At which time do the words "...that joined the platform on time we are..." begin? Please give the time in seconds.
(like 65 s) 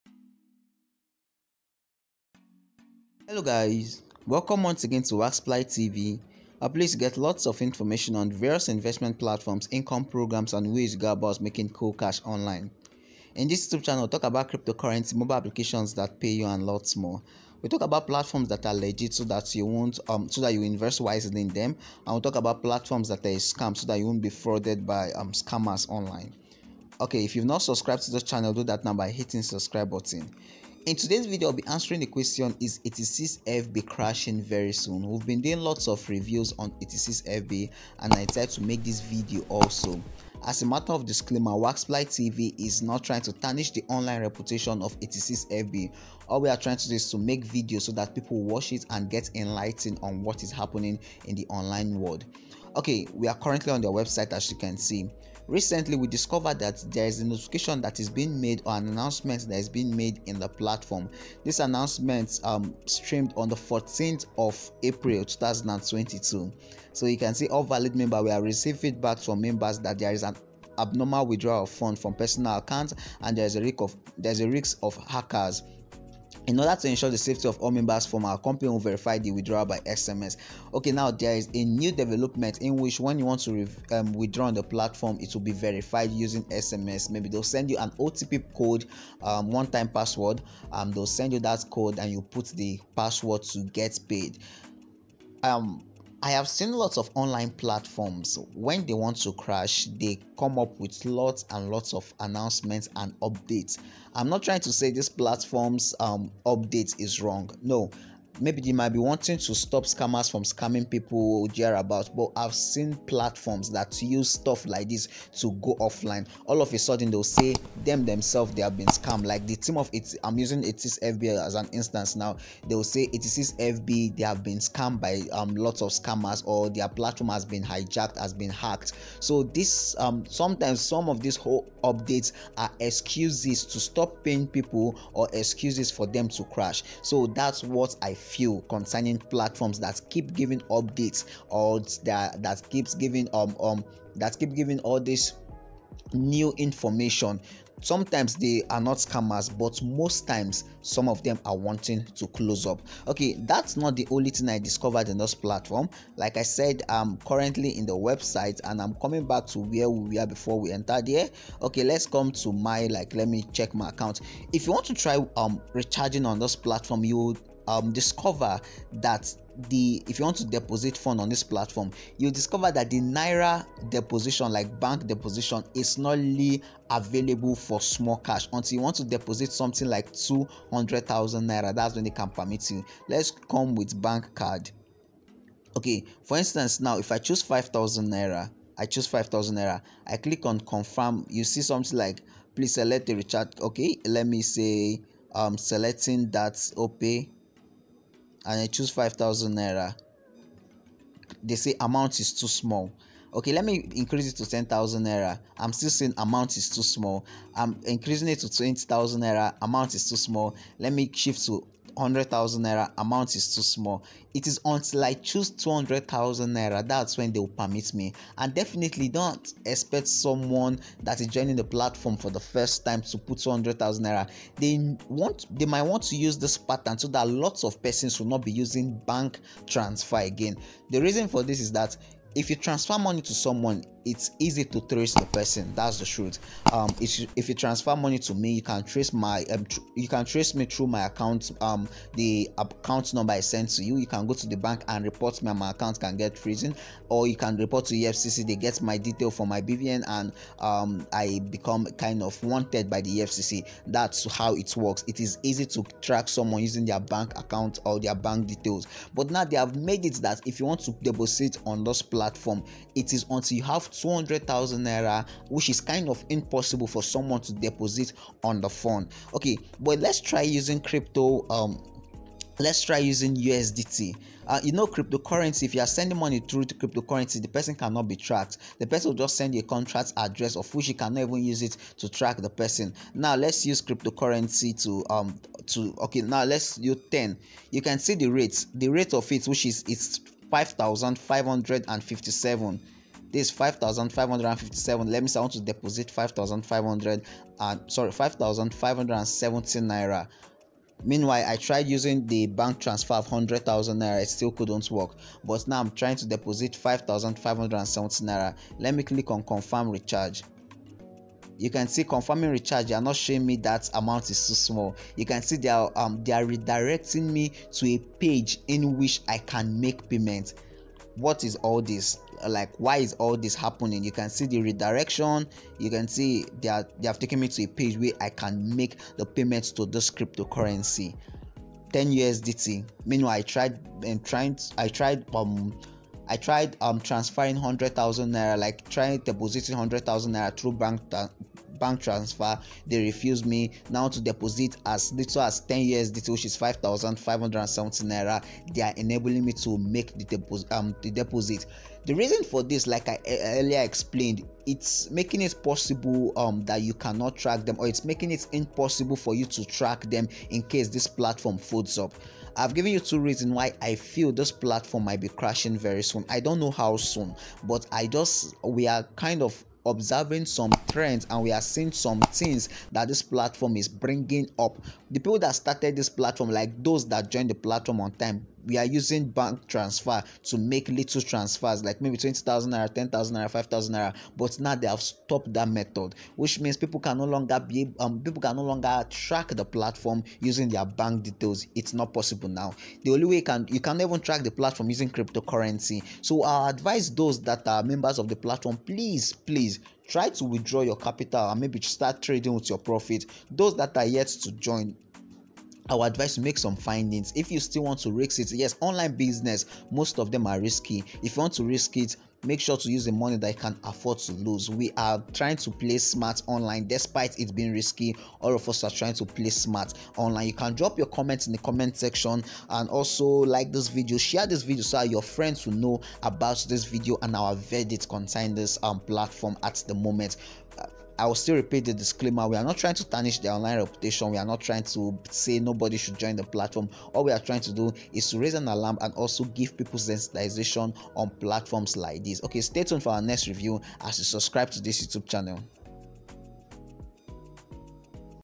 377 s.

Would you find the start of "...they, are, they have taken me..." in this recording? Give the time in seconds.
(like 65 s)
326 s.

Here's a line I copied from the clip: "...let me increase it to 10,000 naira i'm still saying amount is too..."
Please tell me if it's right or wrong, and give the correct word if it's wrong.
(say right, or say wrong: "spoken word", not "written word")
right.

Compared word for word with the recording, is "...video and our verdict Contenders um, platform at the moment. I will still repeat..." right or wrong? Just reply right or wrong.
right.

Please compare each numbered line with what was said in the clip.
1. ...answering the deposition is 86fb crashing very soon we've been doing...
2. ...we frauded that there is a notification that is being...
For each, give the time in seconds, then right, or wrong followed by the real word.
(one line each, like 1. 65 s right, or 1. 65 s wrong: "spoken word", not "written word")
1. 31 s wrong: "question", not "deposition"
2. 55 s wrong: "discovered", not "frauded".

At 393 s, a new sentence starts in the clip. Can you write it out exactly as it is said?
The only way you can you can even track the platform using cryptocurrency.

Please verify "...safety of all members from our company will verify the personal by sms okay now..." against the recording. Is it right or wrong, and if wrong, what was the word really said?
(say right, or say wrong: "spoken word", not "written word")
wrong: "withdrawal", not "personal".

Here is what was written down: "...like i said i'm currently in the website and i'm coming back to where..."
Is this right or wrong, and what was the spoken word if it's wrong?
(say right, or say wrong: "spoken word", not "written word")
right.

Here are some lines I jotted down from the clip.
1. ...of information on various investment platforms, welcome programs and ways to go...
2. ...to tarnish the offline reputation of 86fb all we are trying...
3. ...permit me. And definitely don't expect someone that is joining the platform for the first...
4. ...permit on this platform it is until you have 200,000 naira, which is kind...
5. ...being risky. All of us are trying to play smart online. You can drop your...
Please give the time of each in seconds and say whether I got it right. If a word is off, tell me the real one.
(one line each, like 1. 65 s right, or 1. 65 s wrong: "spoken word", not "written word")
1. 7 s wrong: "income", not "welcome"
2. 43 s wrong: "online", not "offline"
3. 217 s right
4. 261 s wrong: "deposit", not "permit"
5. 417 s right.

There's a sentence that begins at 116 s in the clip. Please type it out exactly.
All of a sudden, they'll say them themselves they have been scammed.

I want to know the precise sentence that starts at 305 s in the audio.
But now I'm trying to deposit 5,570 naira.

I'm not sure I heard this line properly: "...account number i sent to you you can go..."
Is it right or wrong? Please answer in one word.
right.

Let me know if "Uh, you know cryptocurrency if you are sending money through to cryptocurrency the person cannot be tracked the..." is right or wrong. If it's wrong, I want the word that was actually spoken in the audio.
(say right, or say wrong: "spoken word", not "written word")
right.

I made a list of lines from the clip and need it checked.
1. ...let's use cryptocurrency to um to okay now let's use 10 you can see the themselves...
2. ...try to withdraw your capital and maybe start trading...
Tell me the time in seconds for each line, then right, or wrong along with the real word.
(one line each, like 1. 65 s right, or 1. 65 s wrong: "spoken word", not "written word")
1. 283 s wrong: "rates", not "themselves"
2. 400 s right.